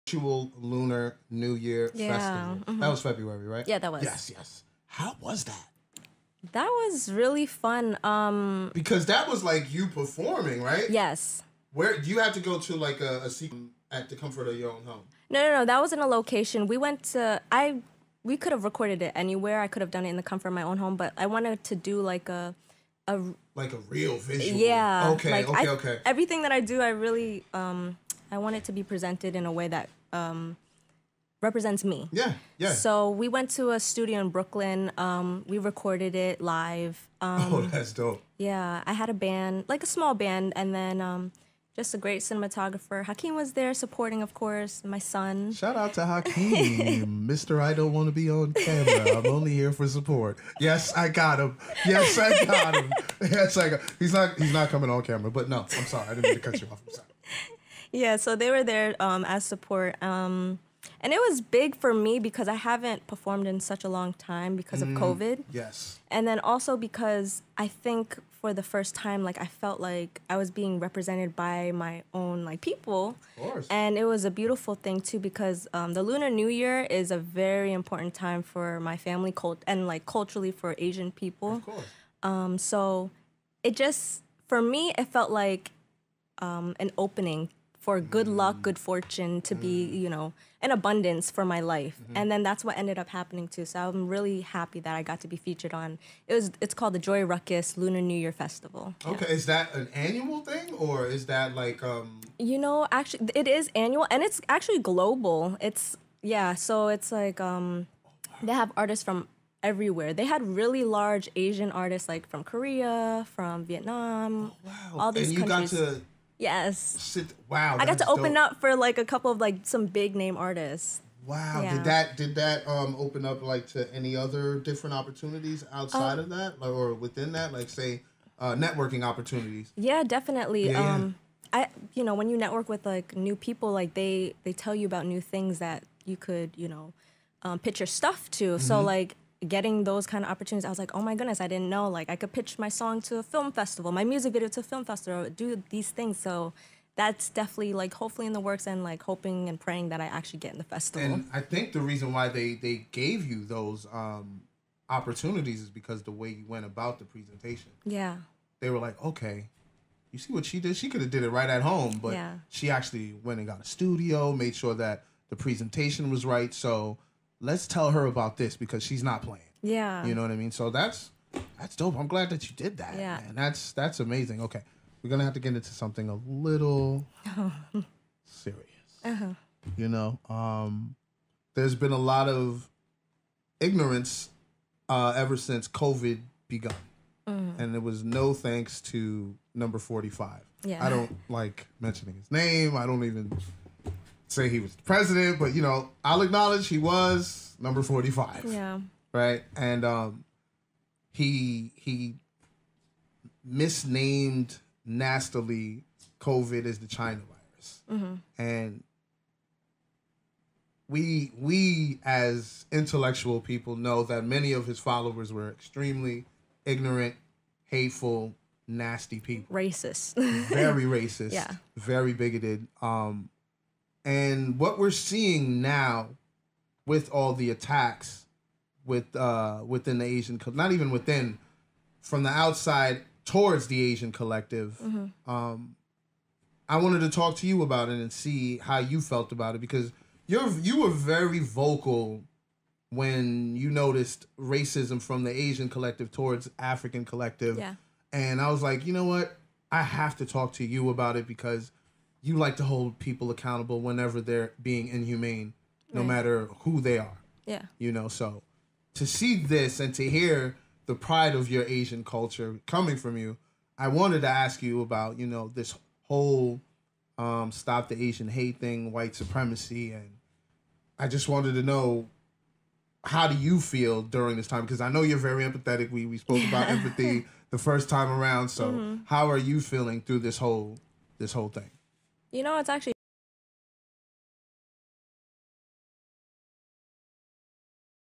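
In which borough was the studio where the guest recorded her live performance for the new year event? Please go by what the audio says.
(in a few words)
Brooklyn.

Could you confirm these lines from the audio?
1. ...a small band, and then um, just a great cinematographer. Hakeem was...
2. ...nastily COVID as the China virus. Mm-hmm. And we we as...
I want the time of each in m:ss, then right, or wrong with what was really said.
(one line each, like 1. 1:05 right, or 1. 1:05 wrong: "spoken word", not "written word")
1. 0:39 right
2. 3:24 right.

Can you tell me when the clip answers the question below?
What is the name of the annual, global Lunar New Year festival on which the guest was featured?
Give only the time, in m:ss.
1:37.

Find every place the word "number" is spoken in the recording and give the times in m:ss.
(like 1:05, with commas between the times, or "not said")
3:09, 3:17.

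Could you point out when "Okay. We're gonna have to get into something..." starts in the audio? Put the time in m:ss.
2:54.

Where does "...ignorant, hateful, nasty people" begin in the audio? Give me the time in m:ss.
3:36.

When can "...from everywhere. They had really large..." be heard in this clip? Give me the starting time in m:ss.
1:49.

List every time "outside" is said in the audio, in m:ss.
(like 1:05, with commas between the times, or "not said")
2:05, 3:52.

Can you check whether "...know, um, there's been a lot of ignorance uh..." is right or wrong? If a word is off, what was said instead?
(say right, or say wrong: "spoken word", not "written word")
right.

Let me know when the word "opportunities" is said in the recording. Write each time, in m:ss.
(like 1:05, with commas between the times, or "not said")
2:04, 2:09, 2:20, 2:34.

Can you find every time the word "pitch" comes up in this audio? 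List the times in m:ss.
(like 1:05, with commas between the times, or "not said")
2:17, 2:22.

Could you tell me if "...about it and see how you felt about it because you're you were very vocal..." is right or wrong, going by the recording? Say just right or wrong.
right.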